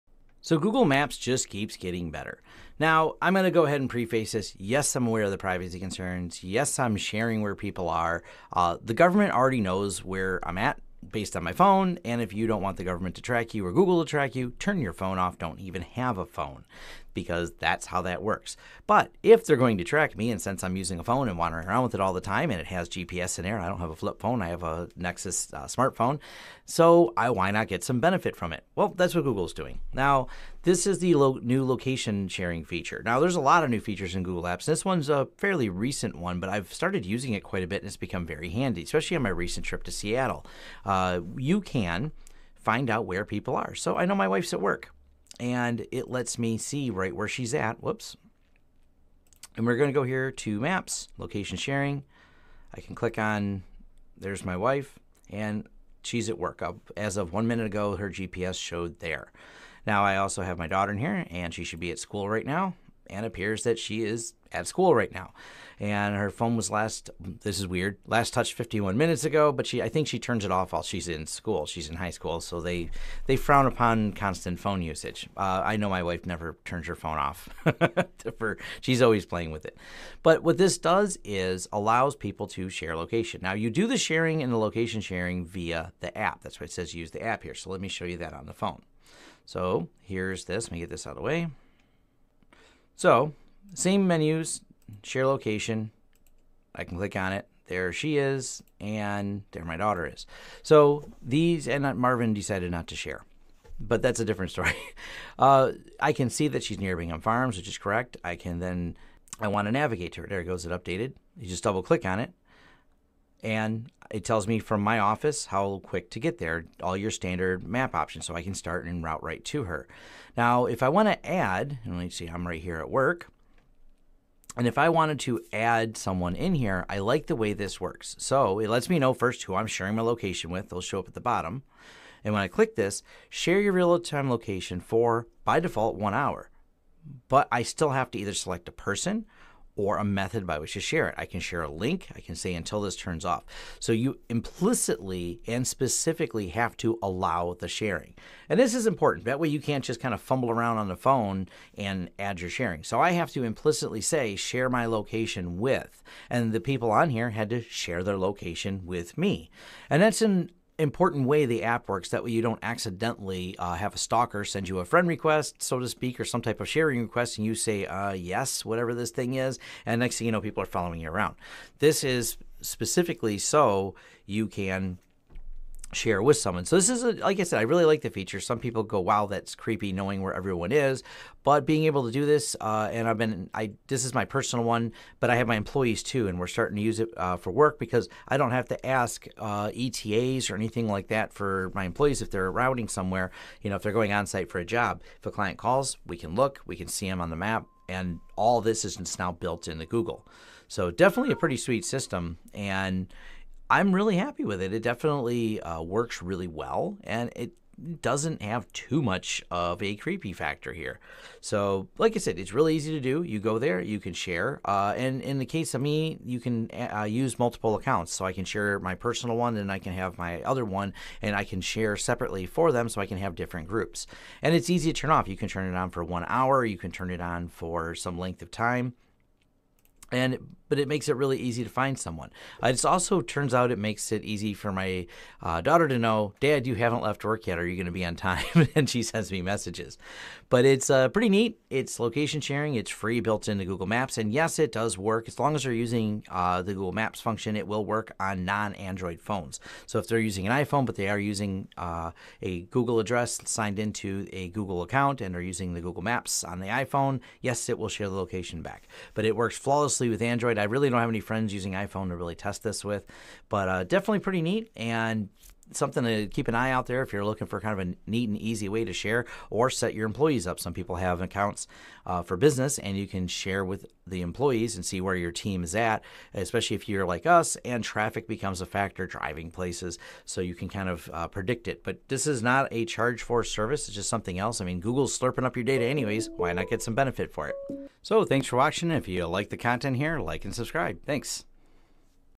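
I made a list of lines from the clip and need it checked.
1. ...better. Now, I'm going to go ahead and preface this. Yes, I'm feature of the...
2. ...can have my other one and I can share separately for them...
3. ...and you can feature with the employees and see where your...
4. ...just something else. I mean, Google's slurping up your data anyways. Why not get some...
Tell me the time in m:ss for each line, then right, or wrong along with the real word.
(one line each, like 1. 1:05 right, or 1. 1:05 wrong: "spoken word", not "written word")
1. 0:02 wrong: "aware", not "feature"
2. 3:39 right
3. 4:32 wrong: "share", not "feature"
4. 4:43 right.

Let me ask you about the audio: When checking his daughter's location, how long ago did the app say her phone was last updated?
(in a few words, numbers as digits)
51 minutes.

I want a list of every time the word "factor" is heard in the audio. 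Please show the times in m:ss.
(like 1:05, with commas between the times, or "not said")
3:30, 4:38.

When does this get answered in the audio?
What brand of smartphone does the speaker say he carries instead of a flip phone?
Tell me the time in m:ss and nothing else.
0:24.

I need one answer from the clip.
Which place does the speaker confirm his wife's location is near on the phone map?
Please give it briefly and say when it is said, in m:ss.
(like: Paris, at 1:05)
Bingham Farms, at 1:46.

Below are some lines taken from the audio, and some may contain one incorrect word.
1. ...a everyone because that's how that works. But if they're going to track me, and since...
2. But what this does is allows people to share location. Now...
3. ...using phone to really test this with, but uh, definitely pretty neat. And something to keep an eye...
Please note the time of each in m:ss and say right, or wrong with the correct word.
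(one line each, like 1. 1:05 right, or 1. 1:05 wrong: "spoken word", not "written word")
1. 0:16 wrong: "phone", not "everyone"
2. 1:20 right
3. 4:21 wrong: "iPhone", not "phone".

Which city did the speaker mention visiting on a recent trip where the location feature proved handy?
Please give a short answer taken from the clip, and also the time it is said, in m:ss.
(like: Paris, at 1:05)
Seattle, at 0:39.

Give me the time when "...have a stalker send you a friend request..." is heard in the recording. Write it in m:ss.
2:43.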